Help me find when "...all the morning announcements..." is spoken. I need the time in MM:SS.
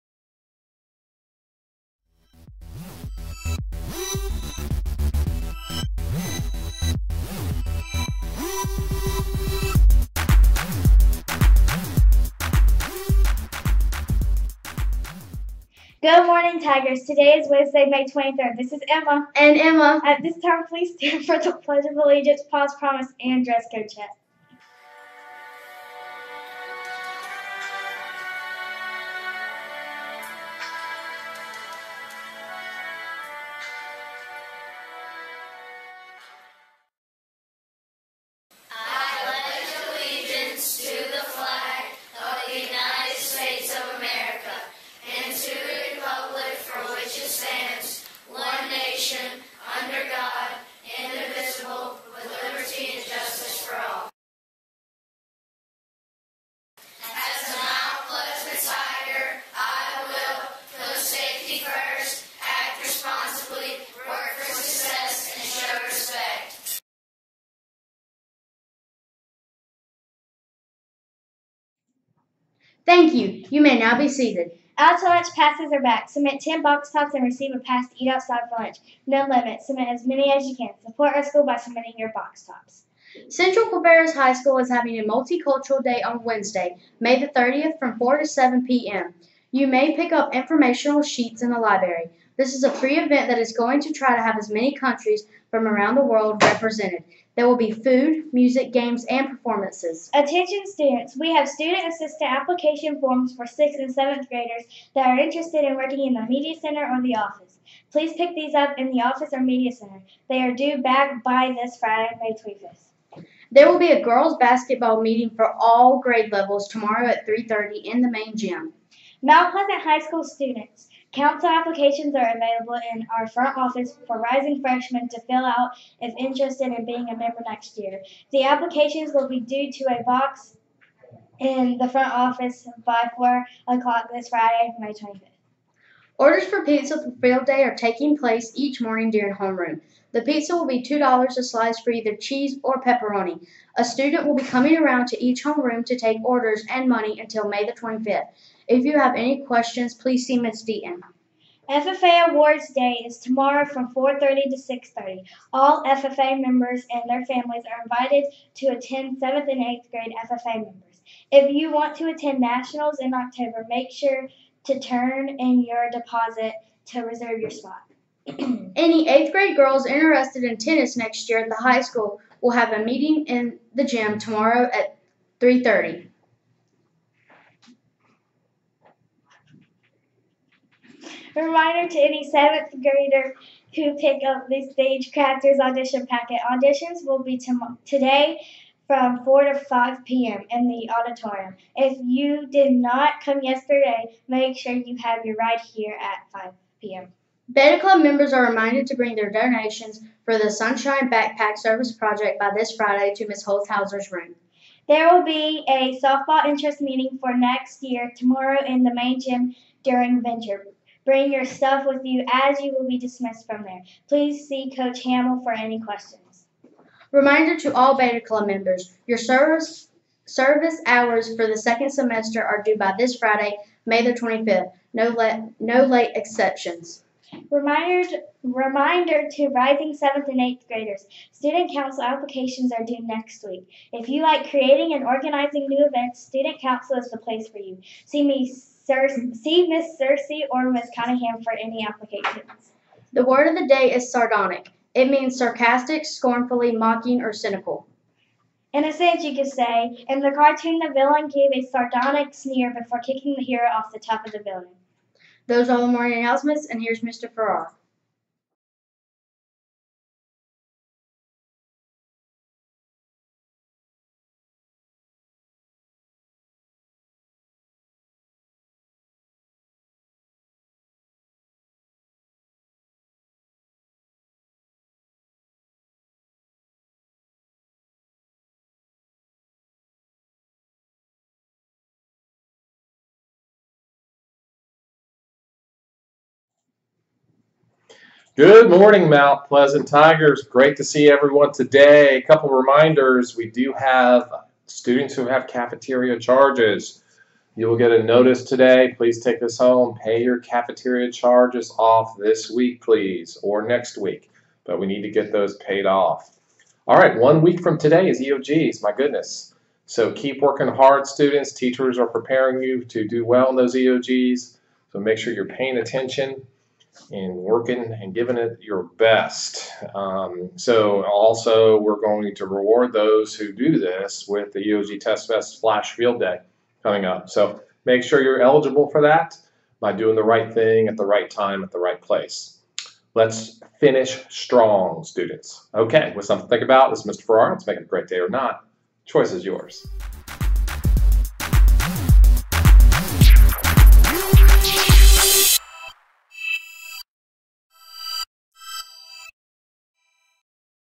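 04:15.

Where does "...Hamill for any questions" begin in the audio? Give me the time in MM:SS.
03:35.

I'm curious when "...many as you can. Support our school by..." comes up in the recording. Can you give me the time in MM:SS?
01:20.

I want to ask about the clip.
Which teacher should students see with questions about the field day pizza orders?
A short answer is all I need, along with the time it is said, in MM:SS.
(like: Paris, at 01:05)
Ms. Deaton, at 02:30.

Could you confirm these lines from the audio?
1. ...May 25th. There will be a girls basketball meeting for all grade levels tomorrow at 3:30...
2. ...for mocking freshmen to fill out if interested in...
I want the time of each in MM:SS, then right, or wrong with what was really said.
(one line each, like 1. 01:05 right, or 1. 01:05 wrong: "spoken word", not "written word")
1. 01:52 right
2. 02:04 wrong: "rising", not "mocking".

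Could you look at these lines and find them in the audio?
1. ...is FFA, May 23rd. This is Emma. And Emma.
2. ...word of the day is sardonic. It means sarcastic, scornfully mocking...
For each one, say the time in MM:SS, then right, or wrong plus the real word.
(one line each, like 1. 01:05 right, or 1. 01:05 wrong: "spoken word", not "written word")
1. 00:17 wrong: "Wednesday", not "FFA"
2. 04:03 right.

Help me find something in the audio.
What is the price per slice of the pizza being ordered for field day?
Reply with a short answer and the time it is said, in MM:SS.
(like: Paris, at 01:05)
$2, at 02:20.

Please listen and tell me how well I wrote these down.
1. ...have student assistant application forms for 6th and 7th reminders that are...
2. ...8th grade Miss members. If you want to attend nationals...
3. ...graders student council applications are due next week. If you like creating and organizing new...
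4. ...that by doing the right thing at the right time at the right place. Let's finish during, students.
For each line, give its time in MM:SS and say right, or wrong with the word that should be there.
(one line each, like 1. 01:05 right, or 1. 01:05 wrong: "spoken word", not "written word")
1. 01:41 wrong: "graders", not "reminders"
2. 02:39 wrong: "FFA", not "Miss"
3. 03:50 right
4. 05:29 wrong: "strong", not "during".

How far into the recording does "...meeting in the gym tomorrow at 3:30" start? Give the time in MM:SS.
02:52.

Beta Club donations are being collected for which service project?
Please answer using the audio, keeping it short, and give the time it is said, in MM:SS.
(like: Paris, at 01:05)
Sunshine Backpack, at 03:20.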